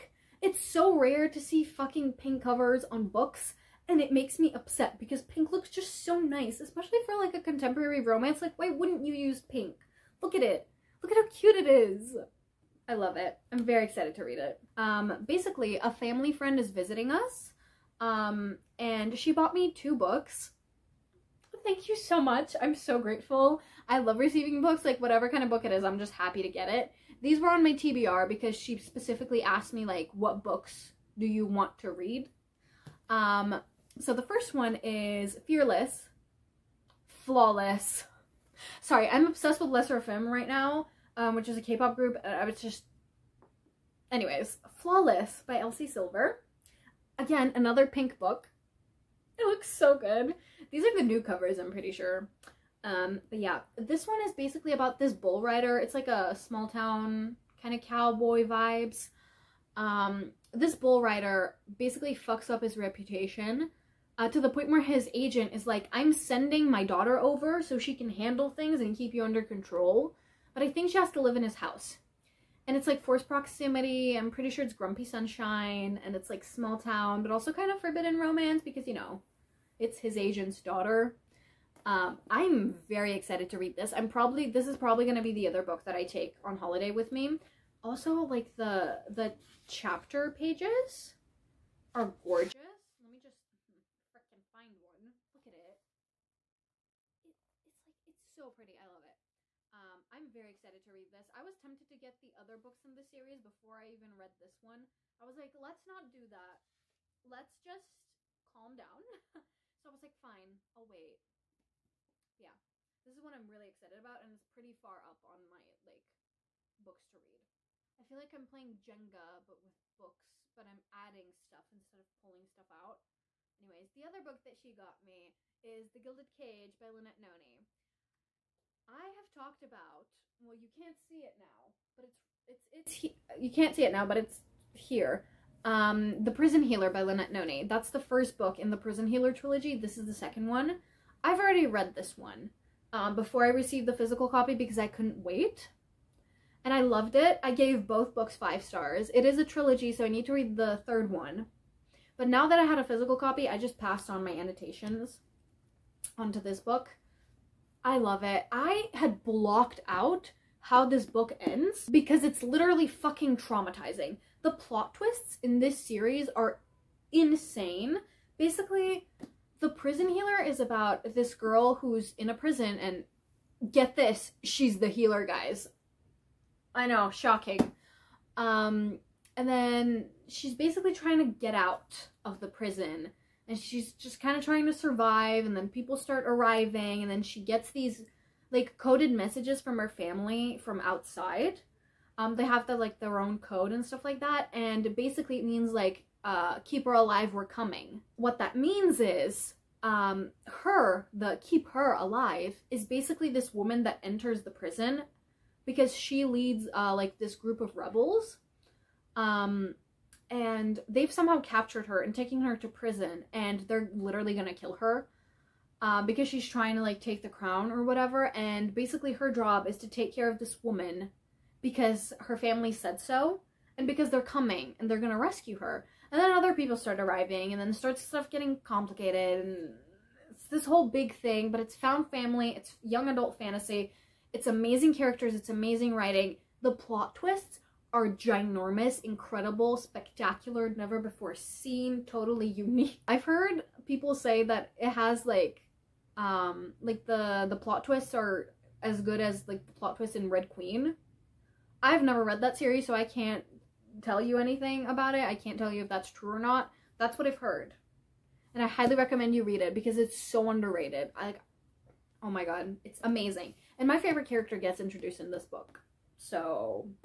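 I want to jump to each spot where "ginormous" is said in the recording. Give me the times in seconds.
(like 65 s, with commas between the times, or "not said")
238 s.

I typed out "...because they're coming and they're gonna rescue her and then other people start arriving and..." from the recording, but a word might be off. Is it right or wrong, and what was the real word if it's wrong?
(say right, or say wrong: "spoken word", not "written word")
right.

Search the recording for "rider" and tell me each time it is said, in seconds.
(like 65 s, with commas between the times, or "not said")
55 s, 61 s.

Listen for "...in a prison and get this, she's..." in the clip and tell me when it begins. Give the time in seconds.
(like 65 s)
172 s.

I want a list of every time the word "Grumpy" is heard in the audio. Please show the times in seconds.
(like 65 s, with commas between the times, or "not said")
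74 s.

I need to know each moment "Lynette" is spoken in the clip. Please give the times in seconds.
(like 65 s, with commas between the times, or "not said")
126 s, 137 s.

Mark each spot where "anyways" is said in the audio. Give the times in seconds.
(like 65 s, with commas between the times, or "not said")
44 s, 123 s.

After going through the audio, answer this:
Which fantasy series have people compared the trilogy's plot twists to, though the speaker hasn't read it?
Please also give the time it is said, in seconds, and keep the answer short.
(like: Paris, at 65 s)
Red Queen, at 250 s.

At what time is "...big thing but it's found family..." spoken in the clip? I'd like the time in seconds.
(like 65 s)
230 s.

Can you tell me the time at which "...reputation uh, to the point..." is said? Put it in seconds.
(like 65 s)
62 s.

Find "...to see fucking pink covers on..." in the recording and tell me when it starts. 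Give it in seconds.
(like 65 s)
1 s.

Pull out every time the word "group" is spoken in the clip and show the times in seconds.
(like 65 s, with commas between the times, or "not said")
41 s, 207 s.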